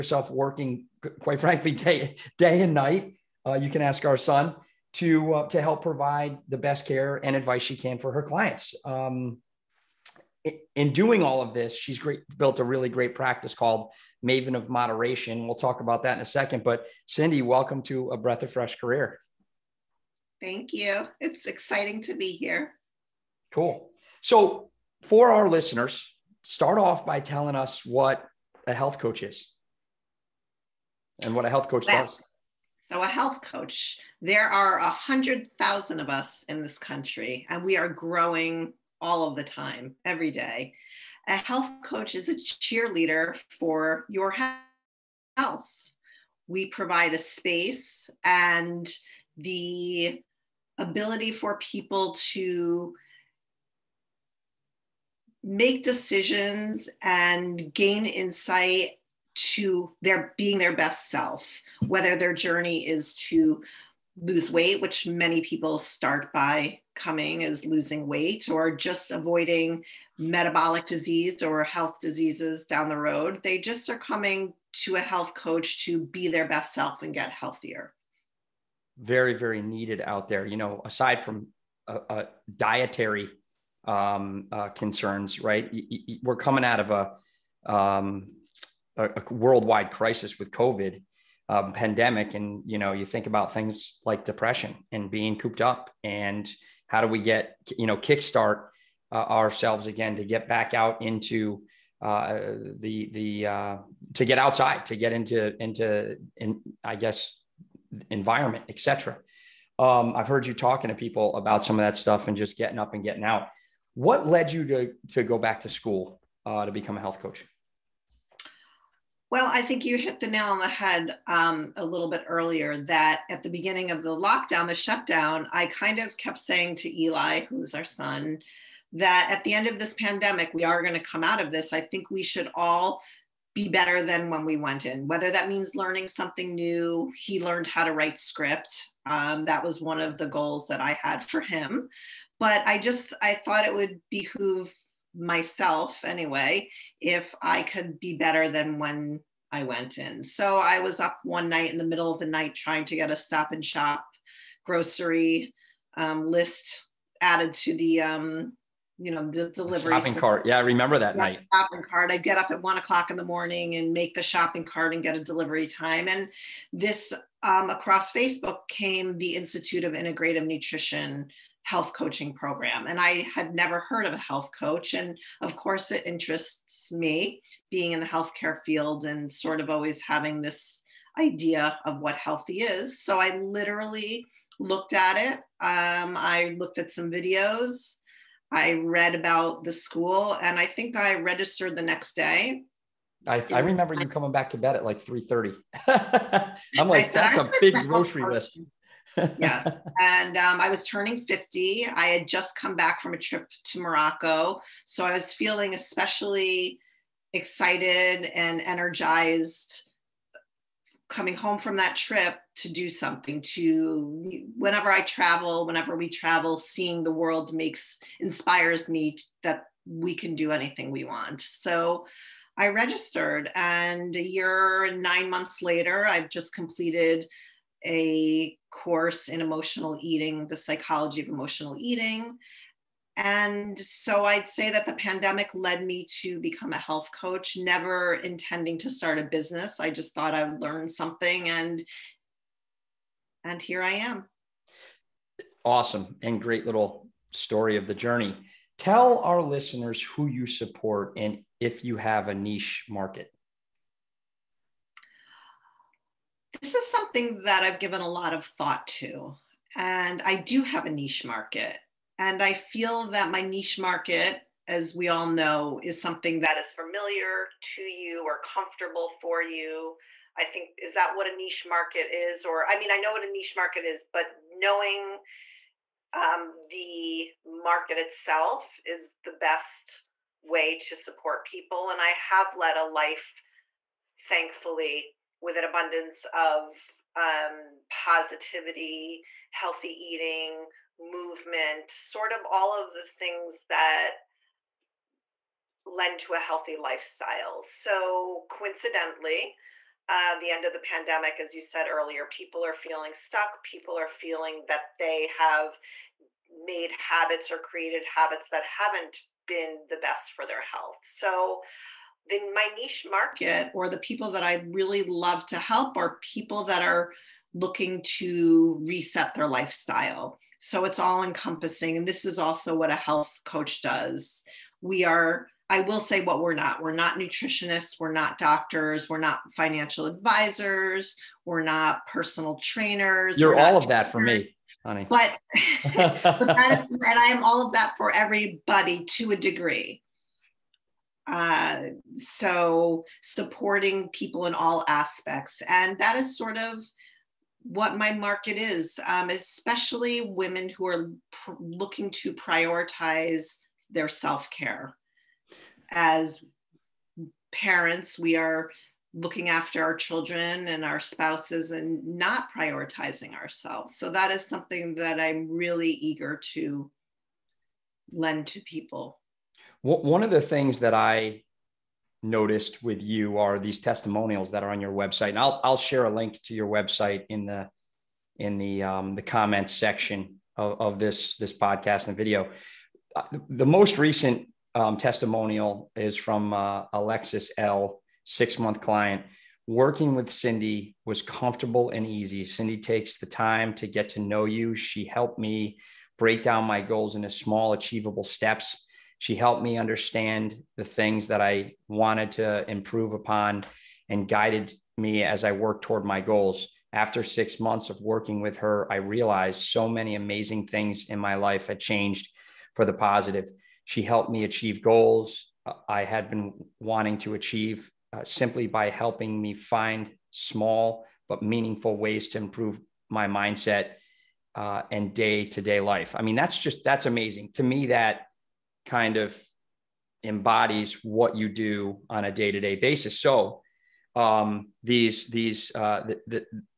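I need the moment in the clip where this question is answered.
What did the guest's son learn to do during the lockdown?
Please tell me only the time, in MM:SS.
02:17.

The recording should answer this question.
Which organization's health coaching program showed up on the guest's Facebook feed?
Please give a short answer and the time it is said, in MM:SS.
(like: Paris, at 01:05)
Institute of Integrative Nutrition, at 02:49.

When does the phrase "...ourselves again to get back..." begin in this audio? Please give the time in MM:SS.
01:39.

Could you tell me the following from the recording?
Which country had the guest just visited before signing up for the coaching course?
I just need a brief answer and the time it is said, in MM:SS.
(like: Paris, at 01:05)
Morocco, at 03:23.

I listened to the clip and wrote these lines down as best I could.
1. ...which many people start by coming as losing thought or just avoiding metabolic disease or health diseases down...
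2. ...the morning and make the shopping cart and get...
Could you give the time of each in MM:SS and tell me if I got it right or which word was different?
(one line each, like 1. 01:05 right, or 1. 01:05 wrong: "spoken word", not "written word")
1. 01:04 wrong: "weight", not "thought"
2. 02:43 right.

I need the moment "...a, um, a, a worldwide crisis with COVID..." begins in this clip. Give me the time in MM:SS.
01:26.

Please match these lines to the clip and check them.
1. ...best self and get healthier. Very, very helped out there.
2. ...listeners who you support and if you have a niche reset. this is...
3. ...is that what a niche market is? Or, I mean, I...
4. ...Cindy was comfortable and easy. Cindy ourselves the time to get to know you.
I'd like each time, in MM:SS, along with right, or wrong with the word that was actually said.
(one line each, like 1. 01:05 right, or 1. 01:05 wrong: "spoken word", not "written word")
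1. 01:16 wrong: "needed", not "helped"
2. 04:09 wrong: "market", not "reset"
3. 04:30 right
4. 06:30 wrong: "takes", not "ourselves".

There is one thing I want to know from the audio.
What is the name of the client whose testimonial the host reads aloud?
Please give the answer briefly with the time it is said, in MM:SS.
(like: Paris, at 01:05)
Alexis L, at 06:26.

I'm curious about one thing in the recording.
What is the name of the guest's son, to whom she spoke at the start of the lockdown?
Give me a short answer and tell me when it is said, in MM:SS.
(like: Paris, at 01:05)
Eli, at 02:07.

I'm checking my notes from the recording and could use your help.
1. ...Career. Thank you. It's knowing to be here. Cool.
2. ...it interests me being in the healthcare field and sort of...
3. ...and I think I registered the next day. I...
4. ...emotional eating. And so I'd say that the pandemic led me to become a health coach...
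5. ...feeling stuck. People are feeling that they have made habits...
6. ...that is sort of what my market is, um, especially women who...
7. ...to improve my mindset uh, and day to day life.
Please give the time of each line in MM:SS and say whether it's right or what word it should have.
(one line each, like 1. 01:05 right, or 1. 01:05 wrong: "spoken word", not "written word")
1. 00:18 wrong: "exciting", not "knowing"
2. 02:55 right
3. 03:10 right
4. 03:51 right
5. 05:02 right
6. 05:45 right
7. 07:02 right.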